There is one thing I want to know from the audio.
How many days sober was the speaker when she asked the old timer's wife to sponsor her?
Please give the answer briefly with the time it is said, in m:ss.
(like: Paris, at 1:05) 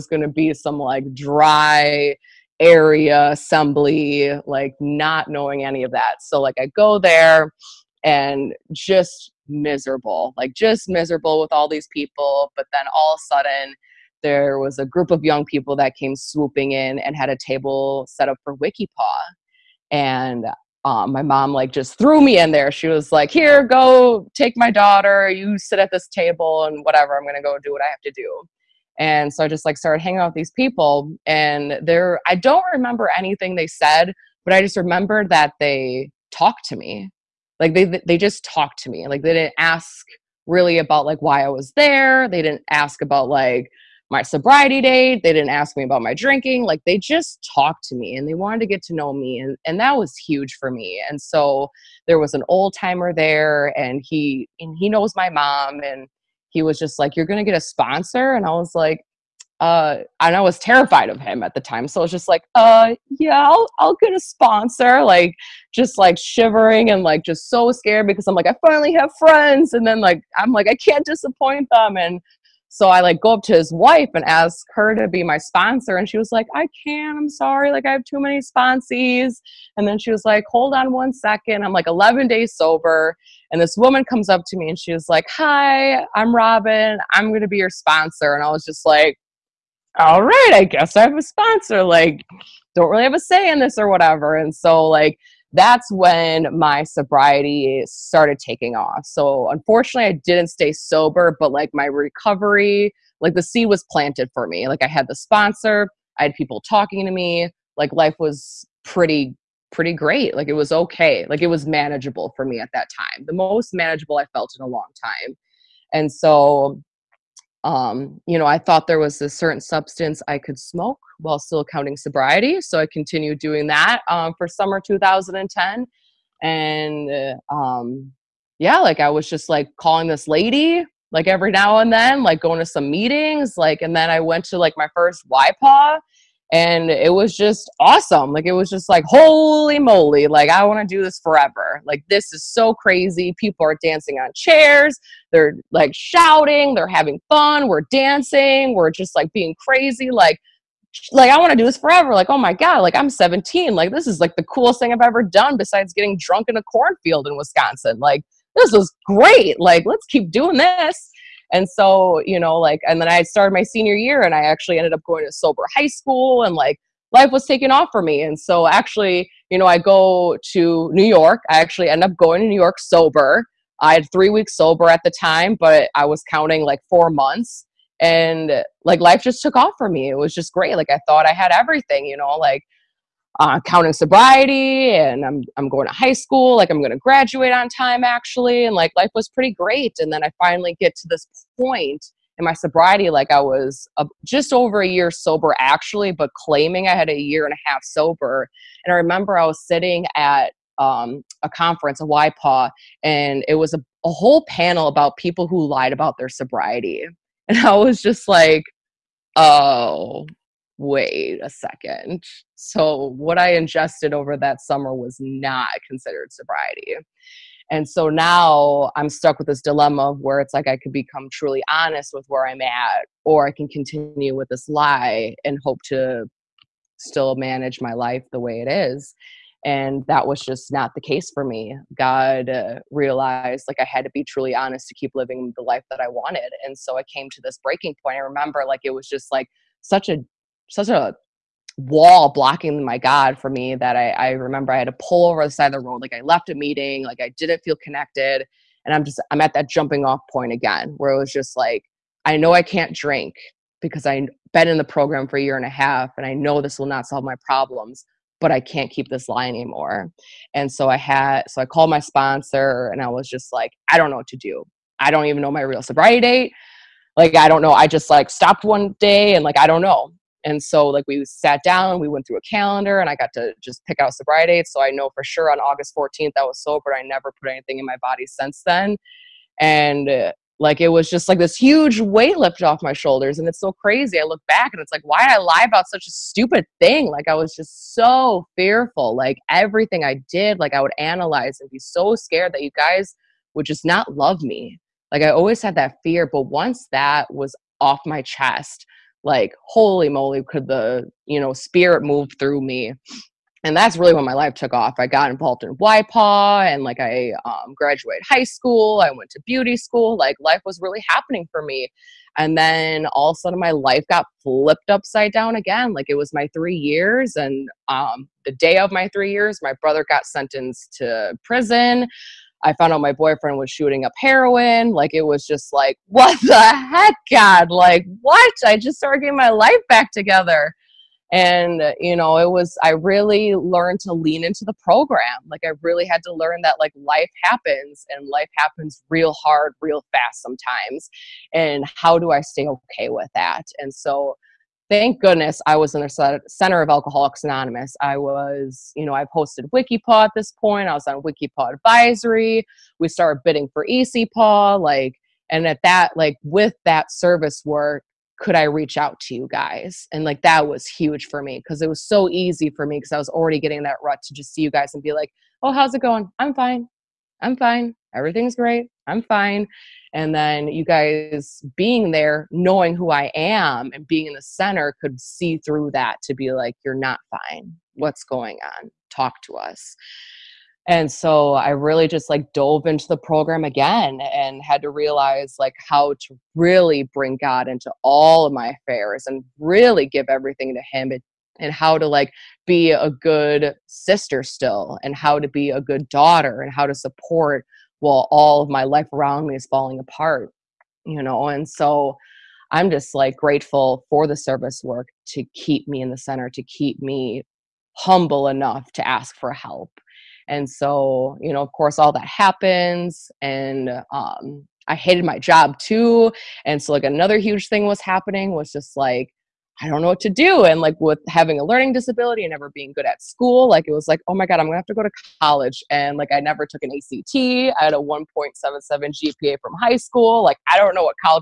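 11, at 1:21.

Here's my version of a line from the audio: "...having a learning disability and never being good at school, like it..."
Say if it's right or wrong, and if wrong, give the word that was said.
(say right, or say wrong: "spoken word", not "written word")
right.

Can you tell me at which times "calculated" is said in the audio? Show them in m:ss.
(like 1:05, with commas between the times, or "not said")
not said.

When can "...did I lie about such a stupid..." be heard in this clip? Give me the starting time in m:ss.
4:45.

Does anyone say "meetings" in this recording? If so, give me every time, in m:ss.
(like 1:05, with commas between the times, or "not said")
2:12, 4:06.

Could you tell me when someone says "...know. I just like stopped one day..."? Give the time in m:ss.
4:27.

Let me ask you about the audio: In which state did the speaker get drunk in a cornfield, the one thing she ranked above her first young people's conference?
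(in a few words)
Wisconsin.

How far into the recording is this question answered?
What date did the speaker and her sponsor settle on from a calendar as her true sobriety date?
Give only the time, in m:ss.
4:35.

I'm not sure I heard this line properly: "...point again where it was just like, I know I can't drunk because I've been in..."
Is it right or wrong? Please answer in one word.
wrong.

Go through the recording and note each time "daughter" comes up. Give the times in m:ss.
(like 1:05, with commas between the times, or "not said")
0:24, 6:36.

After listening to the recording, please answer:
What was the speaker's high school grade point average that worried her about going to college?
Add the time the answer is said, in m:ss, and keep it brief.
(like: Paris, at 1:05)
1.77, at 7:07.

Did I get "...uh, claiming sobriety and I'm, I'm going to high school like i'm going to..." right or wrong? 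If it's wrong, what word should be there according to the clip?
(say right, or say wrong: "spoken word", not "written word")
wrong: "counting", not "claiming".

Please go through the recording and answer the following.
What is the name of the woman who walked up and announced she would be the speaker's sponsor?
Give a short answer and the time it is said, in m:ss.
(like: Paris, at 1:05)
Robin, at 1:26.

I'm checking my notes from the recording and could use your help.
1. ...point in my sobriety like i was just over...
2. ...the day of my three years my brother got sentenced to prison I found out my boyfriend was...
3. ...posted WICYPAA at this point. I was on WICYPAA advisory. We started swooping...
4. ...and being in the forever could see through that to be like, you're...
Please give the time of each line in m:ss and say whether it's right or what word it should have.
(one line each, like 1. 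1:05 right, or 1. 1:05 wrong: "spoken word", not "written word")
1. 3:11 right
2. 5:18 right
3. 5:49 wrong: "bidding", not "swooping"
4. 6:13 wrong: "center", not "forever".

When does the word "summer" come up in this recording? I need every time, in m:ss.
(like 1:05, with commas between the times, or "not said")
2:04, 3:34.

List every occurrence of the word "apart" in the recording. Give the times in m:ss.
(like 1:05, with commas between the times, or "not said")
6:39.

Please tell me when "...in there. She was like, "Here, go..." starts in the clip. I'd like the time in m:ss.
0:22.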